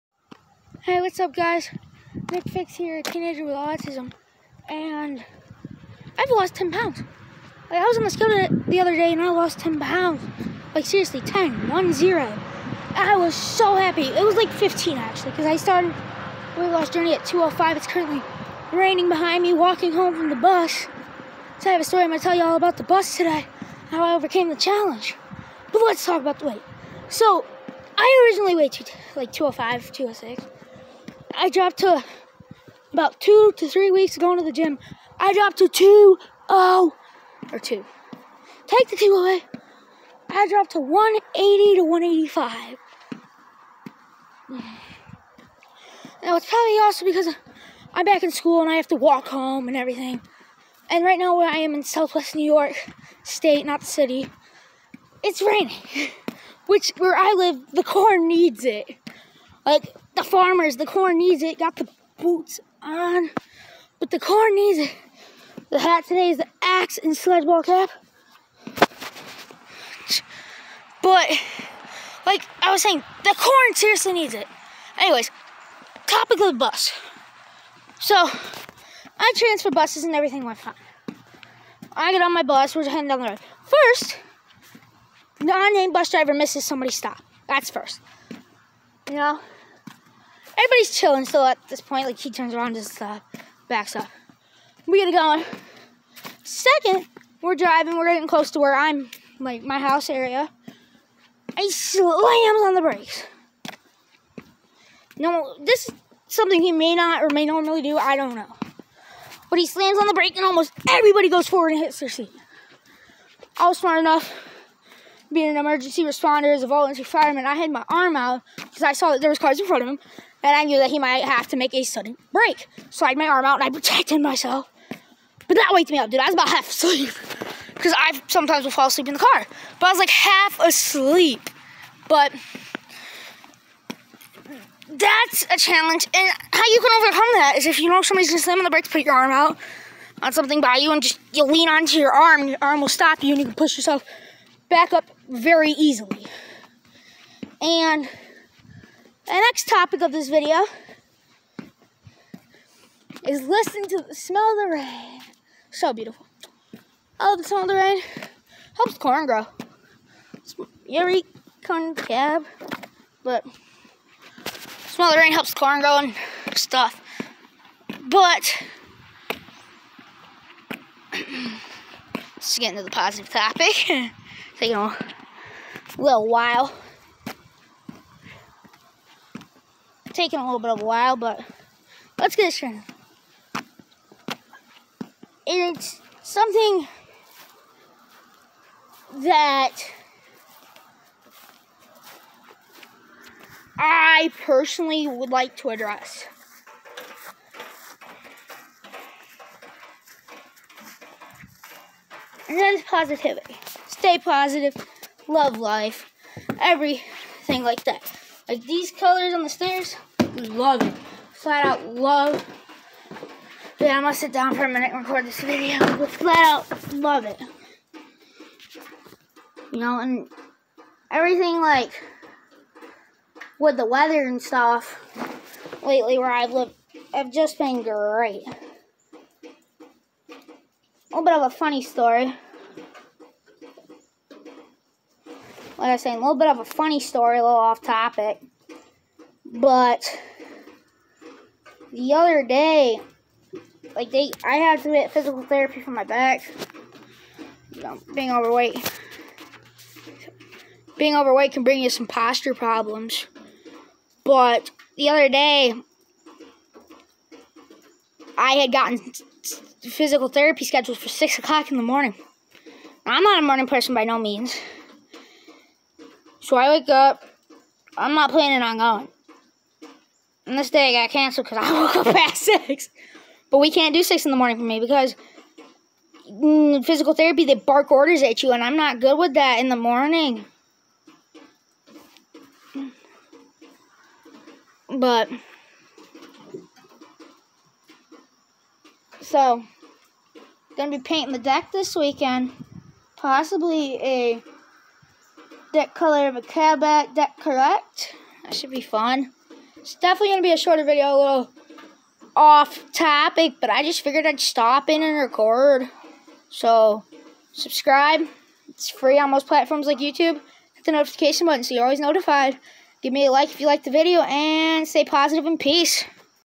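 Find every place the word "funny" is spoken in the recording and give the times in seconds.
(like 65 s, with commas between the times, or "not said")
231 s, 236 s.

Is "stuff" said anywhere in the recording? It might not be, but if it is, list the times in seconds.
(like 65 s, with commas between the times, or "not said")
166 s, 224 s.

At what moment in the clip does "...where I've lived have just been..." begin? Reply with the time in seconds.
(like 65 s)
226 s.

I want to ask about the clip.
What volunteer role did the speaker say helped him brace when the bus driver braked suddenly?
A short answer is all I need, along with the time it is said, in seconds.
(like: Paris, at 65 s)
volunteer fireman, at 116 s.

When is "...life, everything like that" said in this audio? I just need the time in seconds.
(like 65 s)
205 s.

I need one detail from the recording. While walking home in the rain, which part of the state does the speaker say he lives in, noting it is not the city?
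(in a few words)
southwest New York state.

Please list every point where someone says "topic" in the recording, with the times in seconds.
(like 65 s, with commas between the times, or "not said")
76 s, 149 s, 173 s, 237 s, 302 s.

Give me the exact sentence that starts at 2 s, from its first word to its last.
Nick Fix here, a teenager with autism, and I've lost 10 pounds.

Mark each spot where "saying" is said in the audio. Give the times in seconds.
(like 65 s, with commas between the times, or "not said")
72 s, 236 s.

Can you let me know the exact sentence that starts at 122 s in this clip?
So I had my arm out and I protected myself.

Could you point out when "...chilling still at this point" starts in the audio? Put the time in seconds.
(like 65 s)
90 s.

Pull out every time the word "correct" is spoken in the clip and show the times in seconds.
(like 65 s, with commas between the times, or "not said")
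297 s.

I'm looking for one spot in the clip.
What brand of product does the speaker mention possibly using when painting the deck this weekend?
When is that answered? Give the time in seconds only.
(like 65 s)
296 s.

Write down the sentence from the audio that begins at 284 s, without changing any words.
But, so, gonna be painting the deck this weekend.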